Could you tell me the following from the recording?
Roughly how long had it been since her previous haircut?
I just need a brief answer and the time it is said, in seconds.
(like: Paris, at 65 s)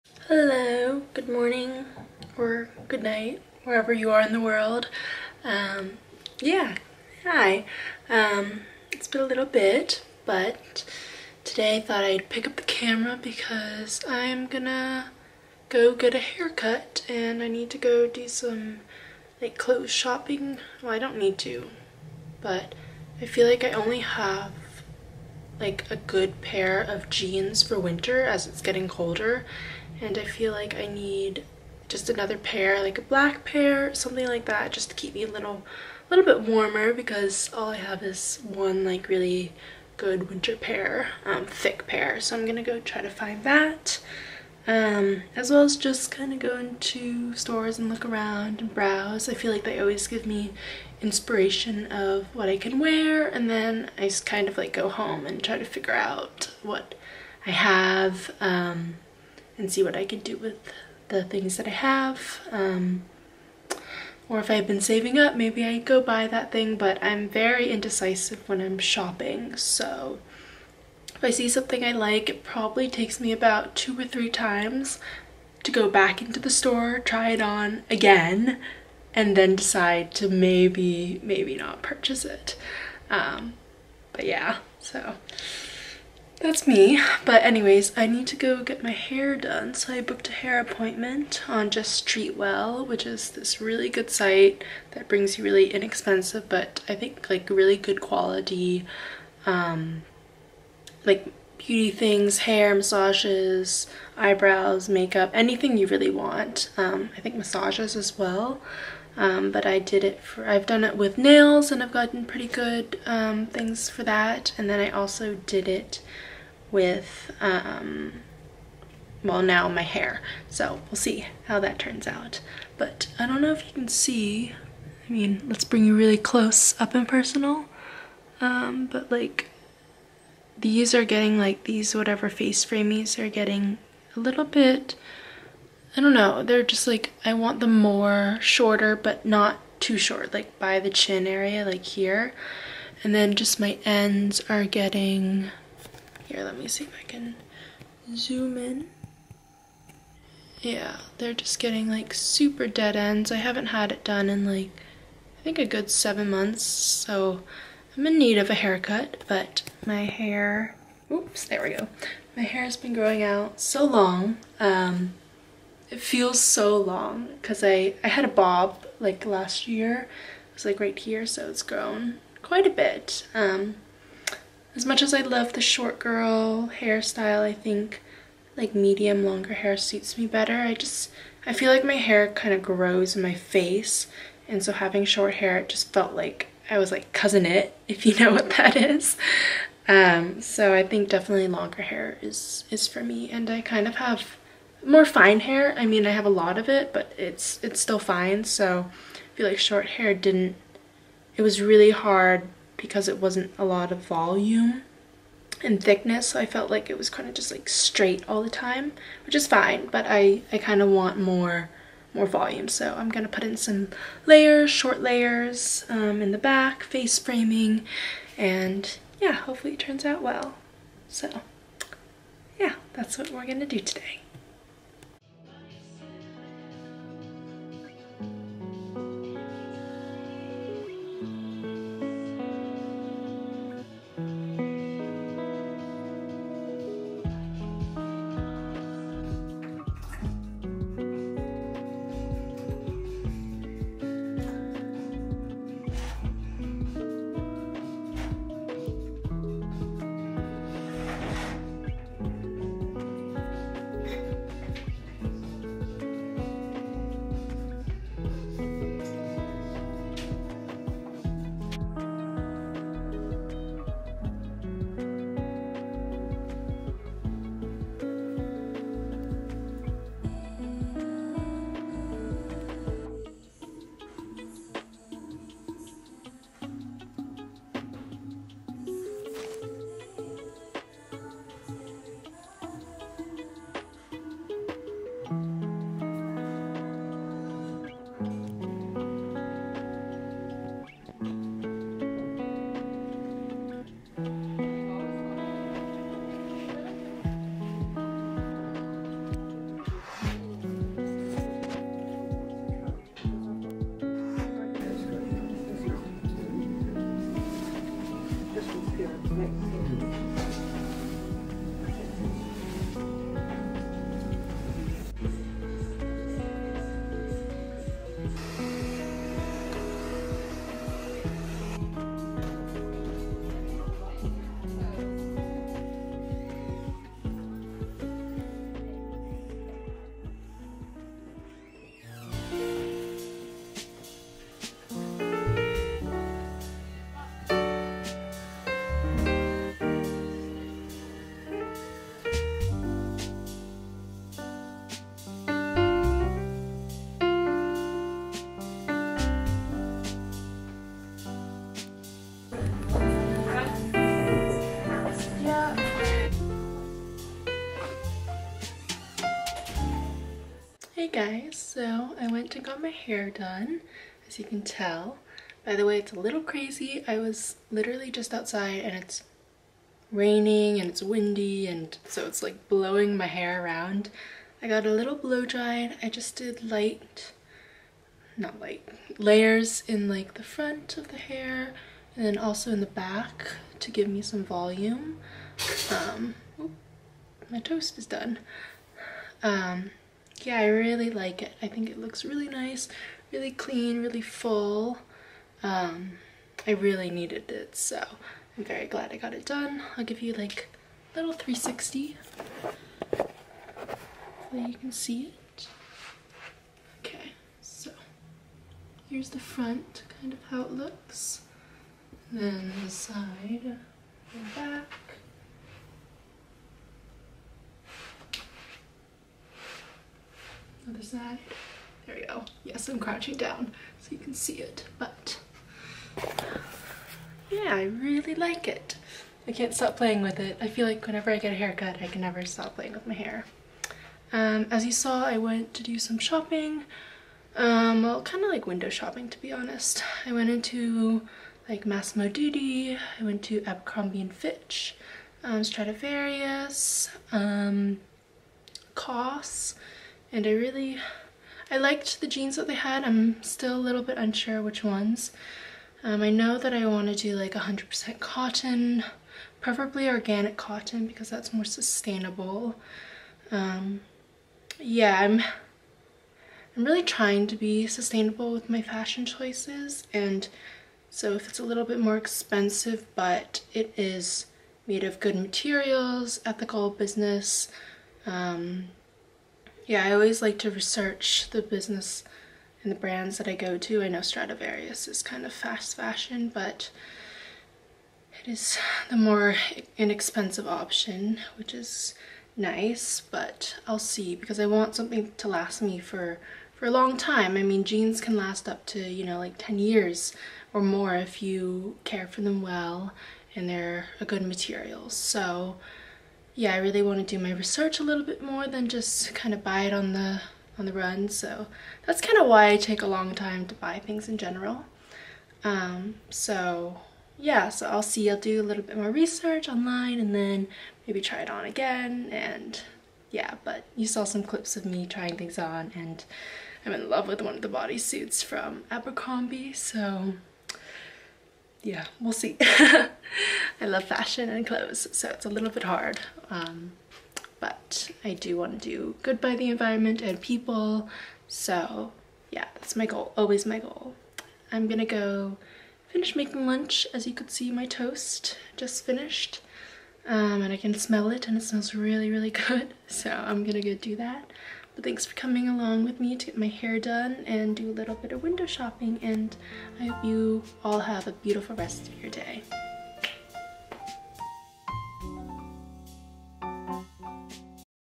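7 months, at 155 s.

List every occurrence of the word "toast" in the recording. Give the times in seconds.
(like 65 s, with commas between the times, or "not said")
387 s, 547 s.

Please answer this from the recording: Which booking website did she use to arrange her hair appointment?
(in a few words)
Just Well.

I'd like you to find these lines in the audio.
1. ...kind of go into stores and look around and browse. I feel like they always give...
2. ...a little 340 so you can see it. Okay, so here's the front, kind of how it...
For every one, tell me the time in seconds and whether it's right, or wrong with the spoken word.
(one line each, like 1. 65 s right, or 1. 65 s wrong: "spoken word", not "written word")
1. 46 s right
2. 401 s wrong: "360", not "340".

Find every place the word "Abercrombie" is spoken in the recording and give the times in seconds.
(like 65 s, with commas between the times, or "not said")
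443 s, 528 s.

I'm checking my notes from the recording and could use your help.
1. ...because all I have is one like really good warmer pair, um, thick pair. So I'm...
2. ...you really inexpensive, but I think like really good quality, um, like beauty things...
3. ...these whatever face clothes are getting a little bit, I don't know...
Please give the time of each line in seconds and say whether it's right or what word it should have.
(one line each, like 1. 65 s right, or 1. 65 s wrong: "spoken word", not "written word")
1. 36 s wrong: "winter", not "warmer"
2. 95 s right
3. 131 s wrong: "framies", not "clothes".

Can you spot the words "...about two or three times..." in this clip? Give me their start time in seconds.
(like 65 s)
73 s.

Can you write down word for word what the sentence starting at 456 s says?
Um, I know that I want to do like 100% cotton, preferably organic cotton because that's more sustainable.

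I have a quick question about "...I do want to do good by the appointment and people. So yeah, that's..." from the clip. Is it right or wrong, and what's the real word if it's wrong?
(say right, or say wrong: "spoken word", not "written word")
wrong: "environment", not "appointment".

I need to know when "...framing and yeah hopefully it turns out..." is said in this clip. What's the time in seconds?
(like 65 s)
217 s.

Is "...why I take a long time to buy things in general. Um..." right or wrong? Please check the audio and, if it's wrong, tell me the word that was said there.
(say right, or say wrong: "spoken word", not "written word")
right.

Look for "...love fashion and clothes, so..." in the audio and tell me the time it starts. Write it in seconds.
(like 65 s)
533 s.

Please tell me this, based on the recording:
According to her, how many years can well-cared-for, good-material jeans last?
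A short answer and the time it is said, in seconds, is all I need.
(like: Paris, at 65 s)
10 years, at 499 s.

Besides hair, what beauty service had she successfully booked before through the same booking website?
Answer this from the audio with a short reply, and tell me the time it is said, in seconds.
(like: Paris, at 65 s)
Nails, at 111 s.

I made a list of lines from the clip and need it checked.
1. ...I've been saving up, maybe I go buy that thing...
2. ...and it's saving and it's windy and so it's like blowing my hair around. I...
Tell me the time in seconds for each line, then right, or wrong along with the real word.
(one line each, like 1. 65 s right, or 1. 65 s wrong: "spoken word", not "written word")
1. 64 s right
2. 368 s wrong: "raining", not "saving".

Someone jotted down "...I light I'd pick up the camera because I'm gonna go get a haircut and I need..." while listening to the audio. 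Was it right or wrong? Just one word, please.
wrong.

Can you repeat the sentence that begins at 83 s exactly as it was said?
Um, but yeah, so that's me.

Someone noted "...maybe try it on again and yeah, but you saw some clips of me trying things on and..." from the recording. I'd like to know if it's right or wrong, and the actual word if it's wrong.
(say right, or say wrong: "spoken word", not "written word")
right.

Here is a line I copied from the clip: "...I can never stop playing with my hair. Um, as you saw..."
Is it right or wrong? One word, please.
right.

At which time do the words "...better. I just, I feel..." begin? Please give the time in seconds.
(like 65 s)
180 s.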